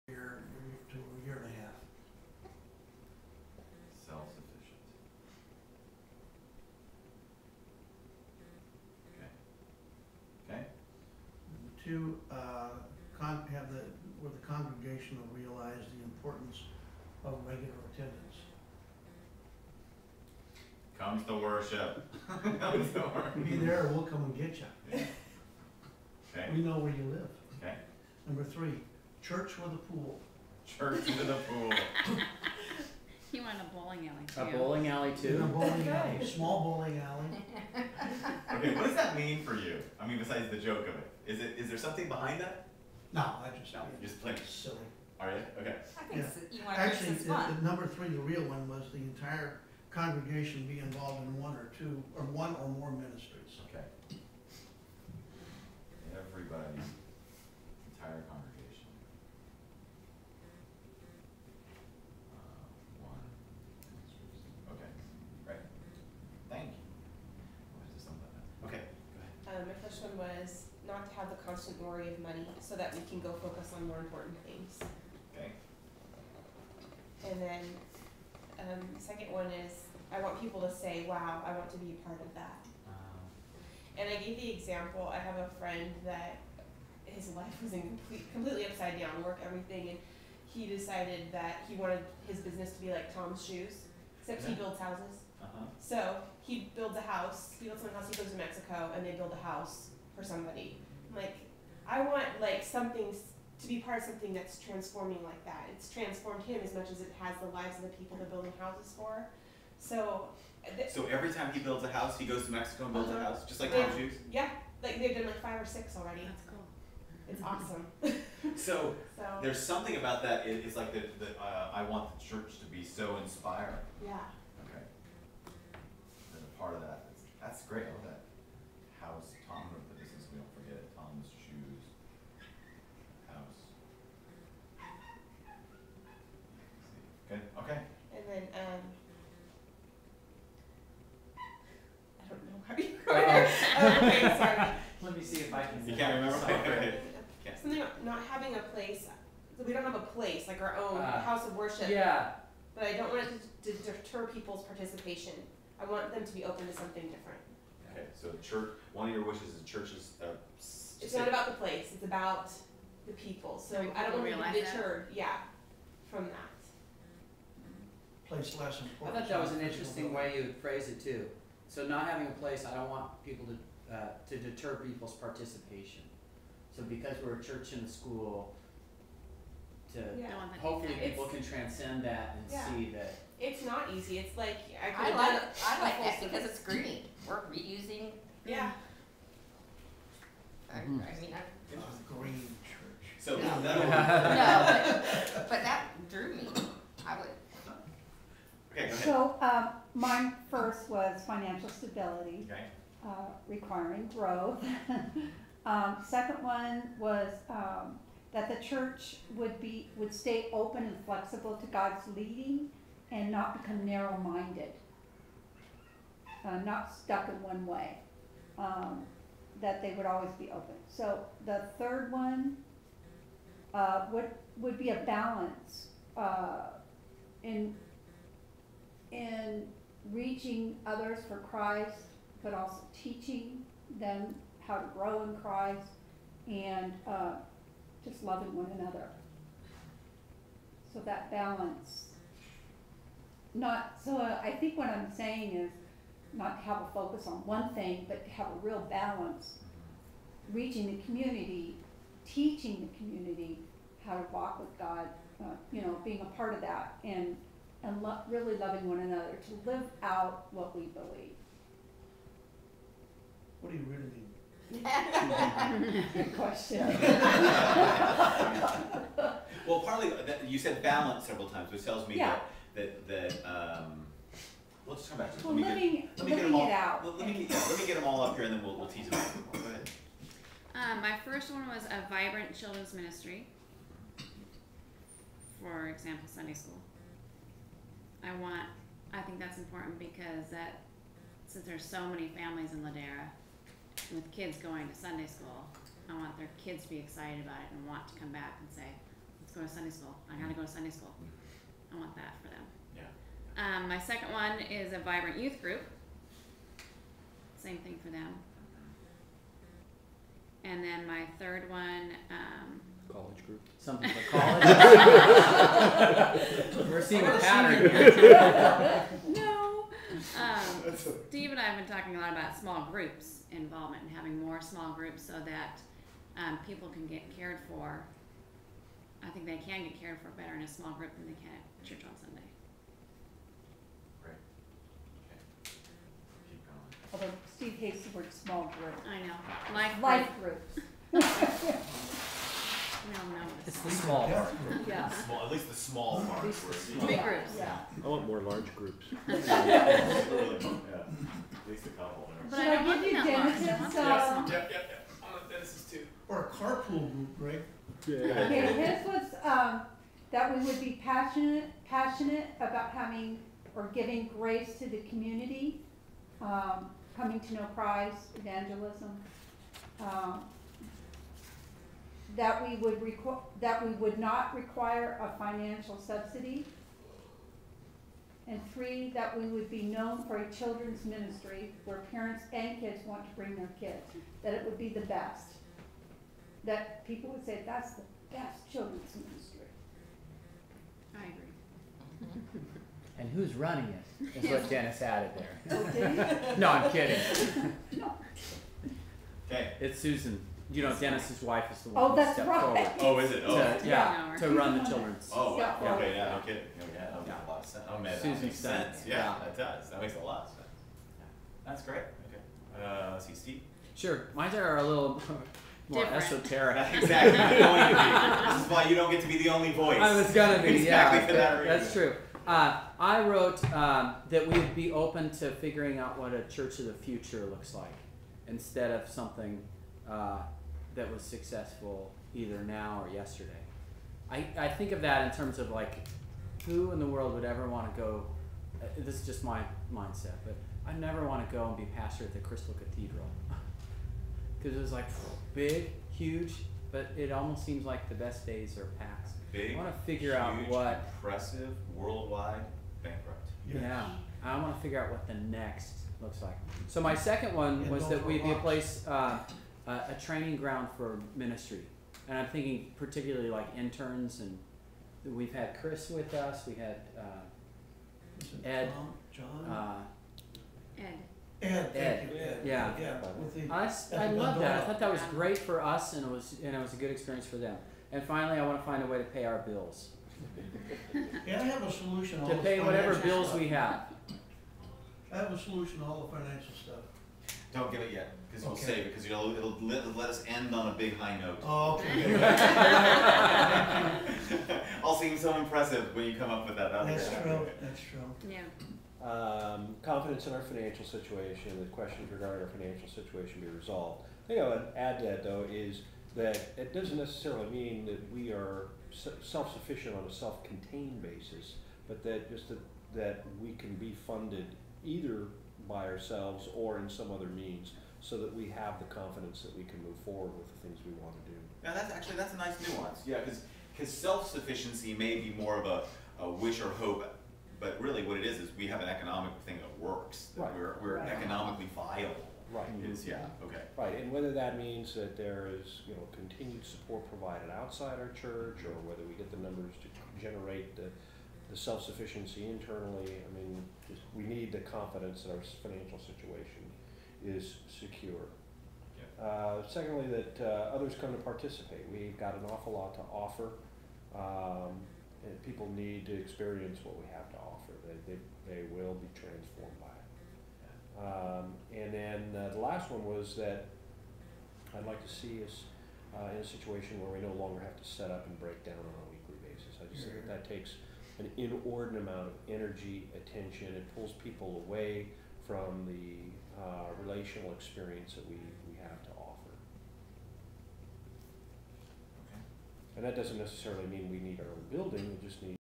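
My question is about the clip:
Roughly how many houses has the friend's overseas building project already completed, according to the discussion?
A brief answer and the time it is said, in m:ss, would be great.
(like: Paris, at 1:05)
5 or 6, at 1:55.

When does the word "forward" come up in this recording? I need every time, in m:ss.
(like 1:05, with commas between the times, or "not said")
6:42, 8:40.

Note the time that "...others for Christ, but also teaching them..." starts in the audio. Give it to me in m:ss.
3:50.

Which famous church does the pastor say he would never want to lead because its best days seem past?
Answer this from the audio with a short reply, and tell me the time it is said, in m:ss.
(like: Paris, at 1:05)
Crystal Cathedral, at 7:22.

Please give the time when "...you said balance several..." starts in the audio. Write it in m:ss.
4:30.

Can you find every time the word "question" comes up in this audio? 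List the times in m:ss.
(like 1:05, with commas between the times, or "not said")
4:26, 8:21.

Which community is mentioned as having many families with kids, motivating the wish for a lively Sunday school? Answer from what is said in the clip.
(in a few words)
Ladera.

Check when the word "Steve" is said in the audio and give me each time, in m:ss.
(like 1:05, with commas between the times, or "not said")
5:37, 6:53.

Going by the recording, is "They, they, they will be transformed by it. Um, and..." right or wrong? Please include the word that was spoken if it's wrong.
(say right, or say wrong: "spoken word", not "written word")
right.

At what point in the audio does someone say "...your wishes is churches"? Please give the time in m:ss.
2:39.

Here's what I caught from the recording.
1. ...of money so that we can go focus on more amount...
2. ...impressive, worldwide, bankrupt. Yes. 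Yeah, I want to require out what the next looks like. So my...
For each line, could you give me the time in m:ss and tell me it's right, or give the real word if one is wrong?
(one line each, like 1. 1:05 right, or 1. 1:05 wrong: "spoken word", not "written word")
1. 1:12 wrong: "important", not "amount"
2. 7:31 wrong: "figure", not "require".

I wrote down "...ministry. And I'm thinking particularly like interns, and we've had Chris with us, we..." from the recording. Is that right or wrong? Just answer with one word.
right.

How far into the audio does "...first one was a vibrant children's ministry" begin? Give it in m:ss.
4:41.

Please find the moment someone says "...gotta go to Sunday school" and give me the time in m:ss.
5:00.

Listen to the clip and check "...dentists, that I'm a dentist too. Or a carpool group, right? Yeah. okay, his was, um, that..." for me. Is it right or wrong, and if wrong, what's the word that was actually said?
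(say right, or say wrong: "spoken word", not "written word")
right.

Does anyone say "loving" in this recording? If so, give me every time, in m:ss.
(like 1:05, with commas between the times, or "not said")
3:58, 4:18.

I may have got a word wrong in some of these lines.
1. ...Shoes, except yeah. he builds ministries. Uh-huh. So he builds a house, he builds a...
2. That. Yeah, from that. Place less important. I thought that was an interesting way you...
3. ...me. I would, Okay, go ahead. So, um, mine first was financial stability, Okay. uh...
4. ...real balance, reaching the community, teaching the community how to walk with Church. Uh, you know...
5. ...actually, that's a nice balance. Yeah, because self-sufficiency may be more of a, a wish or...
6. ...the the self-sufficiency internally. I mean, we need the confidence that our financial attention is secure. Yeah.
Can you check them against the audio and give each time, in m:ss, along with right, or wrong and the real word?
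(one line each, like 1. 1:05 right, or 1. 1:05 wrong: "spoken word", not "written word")
1. 1:33 wrong: "houses", not "ministries"
2. 2:45 right
3. 3:16 right
4. 4:08 wrong: "God", not "Church"
5. 8:42 wrong: "nuance", not "balance"
6. 9:00 wrong: "situation", not "attention".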